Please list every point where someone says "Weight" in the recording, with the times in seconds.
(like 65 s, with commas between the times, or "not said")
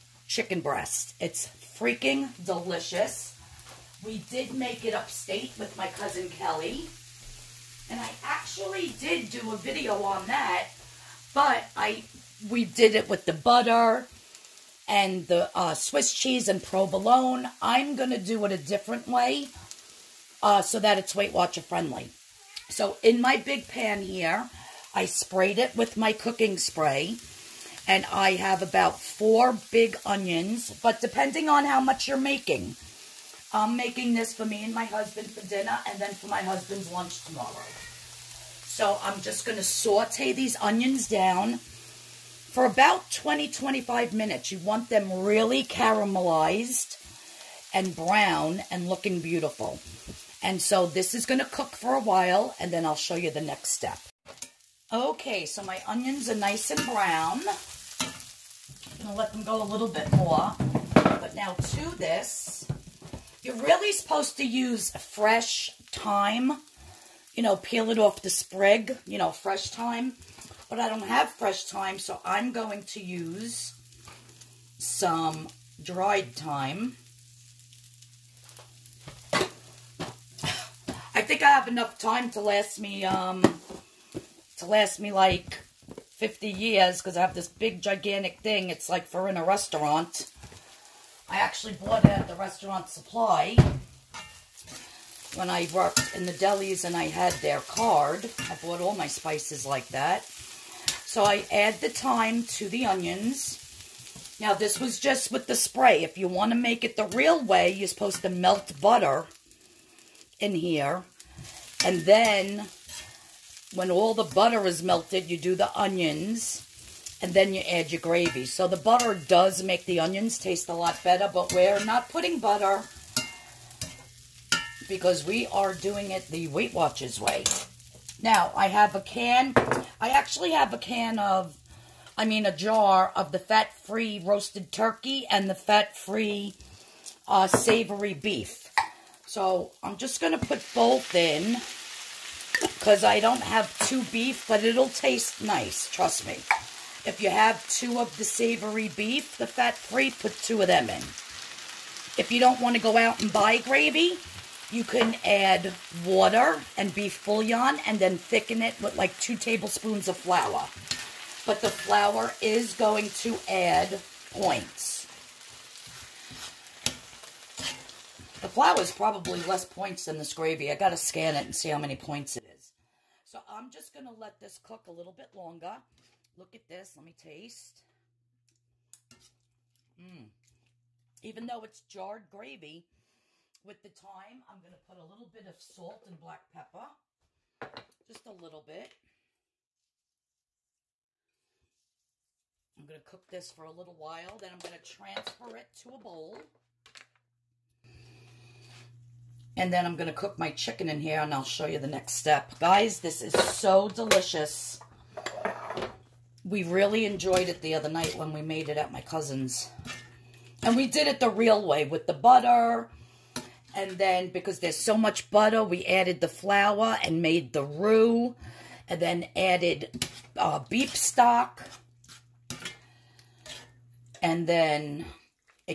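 21 s, 126 s.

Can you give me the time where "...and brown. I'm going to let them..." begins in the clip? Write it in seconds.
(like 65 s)
56 s.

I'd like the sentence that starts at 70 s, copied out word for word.
But I don't have fresh thyme, so I'm going to use some dried thyme.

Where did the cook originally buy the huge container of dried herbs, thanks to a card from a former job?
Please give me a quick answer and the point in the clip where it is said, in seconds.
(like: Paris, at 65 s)
restaurant supply, at 92 s.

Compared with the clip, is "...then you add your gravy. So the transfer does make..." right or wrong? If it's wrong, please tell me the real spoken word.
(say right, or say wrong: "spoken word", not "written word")
wrong: "butter", not "transfer".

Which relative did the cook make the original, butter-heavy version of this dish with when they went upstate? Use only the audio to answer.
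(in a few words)
Kelly.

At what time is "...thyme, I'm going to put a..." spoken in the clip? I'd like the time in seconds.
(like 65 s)
183 s.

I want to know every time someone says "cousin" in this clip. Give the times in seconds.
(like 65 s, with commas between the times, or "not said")
5 s, 209 s.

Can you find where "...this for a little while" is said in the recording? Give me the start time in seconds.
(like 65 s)
193 s.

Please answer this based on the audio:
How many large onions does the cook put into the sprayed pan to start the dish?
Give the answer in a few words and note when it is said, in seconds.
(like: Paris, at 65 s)
4, at 29 s.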